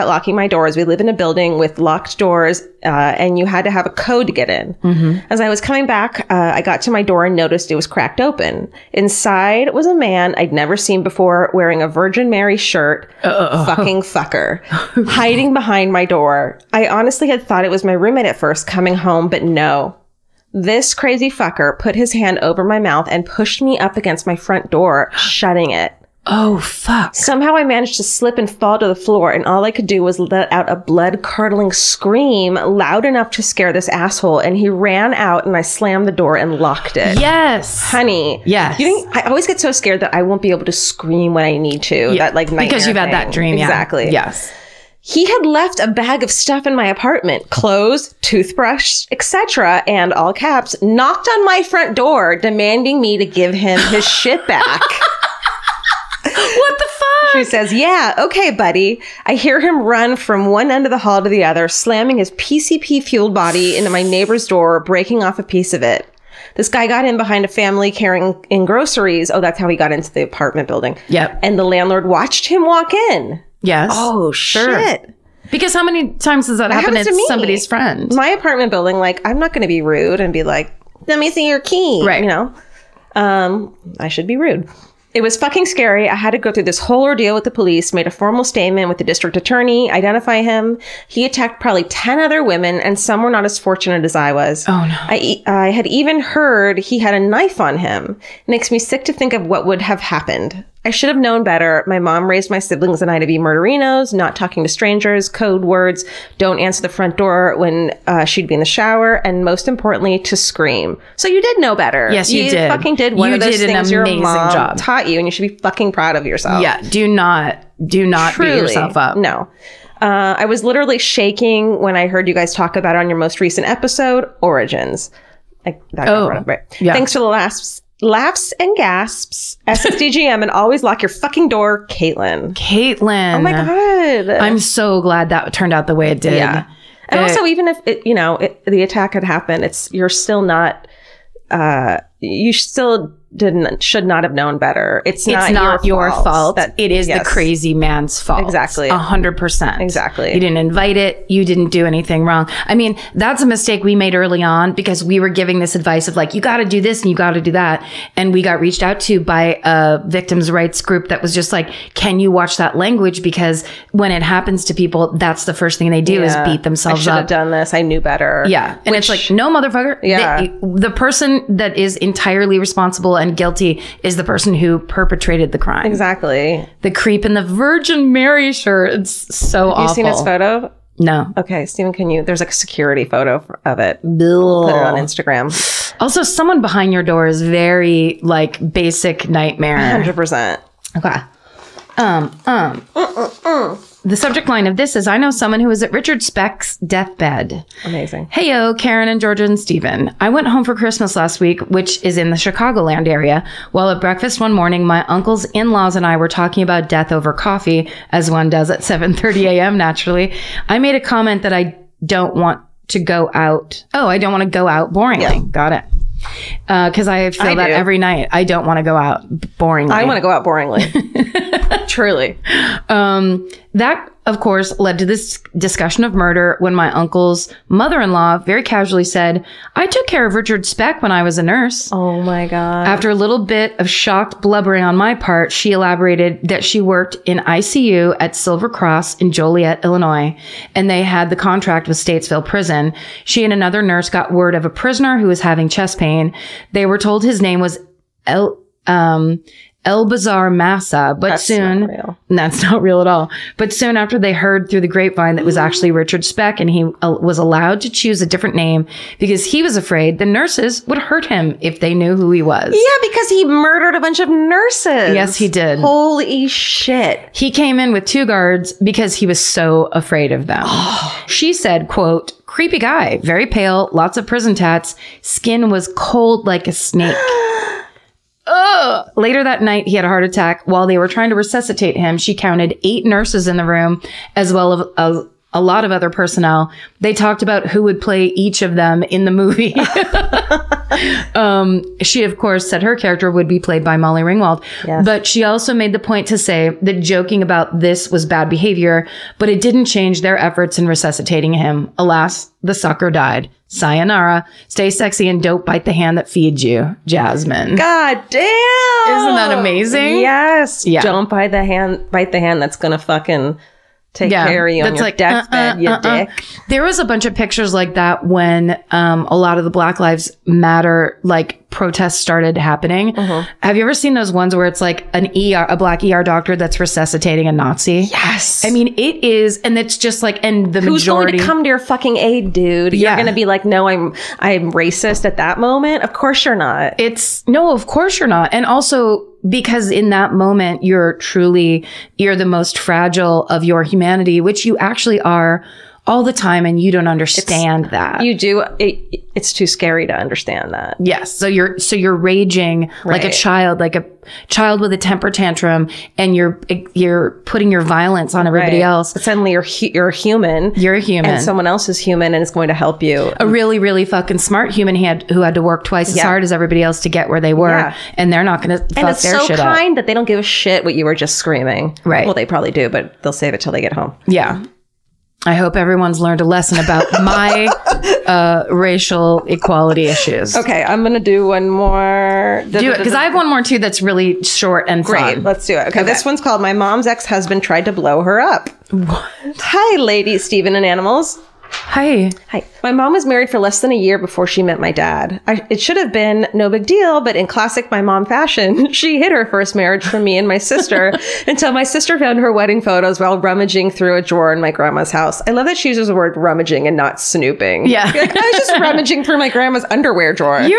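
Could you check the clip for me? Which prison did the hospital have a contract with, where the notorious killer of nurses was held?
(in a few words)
Statesville Prison.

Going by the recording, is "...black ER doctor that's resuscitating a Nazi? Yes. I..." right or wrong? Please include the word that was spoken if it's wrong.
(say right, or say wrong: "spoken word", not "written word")
right.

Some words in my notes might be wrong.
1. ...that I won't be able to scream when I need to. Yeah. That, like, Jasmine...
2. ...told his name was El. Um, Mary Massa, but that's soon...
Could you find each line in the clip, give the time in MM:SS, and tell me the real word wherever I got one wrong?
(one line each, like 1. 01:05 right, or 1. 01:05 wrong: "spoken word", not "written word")
1. 00:39 wrong: "Because", not "Jasmine"
2. 04:06 wrong: "Elbazar", not "Mary".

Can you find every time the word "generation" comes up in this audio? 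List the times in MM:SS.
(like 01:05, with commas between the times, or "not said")
not said.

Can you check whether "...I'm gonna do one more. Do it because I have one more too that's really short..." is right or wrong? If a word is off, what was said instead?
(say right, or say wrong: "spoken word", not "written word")
right.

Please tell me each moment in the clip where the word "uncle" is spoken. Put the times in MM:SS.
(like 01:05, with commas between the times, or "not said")
03:25, 03:46.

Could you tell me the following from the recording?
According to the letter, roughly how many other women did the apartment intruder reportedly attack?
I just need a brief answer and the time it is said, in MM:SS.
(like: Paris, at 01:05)
10, at 01:31.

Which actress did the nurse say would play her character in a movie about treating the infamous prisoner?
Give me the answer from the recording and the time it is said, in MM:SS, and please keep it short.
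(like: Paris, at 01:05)
Molly Ringwald, at 04:53.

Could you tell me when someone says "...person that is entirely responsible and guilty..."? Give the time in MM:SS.
02:50.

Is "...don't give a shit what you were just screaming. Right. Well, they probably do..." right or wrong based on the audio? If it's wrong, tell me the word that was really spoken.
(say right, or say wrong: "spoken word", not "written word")
right.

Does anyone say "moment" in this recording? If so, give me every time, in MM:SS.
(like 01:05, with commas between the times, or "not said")
05:35, 05:40.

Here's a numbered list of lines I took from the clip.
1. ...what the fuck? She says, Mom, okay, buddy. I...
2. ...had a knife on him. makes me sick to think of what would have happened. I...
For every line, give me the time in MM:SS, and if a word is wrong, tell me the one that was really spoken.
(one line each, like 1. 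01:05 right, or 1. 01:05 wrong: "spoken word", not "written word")
1. 00:56 wrong: "Yeah", not "Mom"
2. 01:36 right.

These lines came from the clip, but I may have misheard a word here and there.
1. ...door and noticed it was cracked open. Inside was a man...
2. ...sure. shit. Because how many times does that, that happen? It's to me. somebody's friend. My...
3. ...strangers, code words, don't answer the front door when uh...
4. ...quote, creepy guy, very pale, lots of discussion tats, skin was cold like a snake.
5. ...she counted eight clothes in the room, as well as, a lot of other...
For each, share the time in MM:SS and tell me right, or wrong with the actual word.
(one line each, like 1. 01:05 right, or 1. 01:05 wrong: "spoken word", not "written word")
1. 00:07 right
2. 01:14 right
3. 01:44 right
4. 04:31 wrong: "prison", not "discussion"
5. 04:42 wrong: "nurses", not "clothes".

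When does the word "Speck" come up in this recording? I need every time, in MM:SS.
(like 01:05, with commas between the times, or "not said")
03:16, 03:50, 04:16.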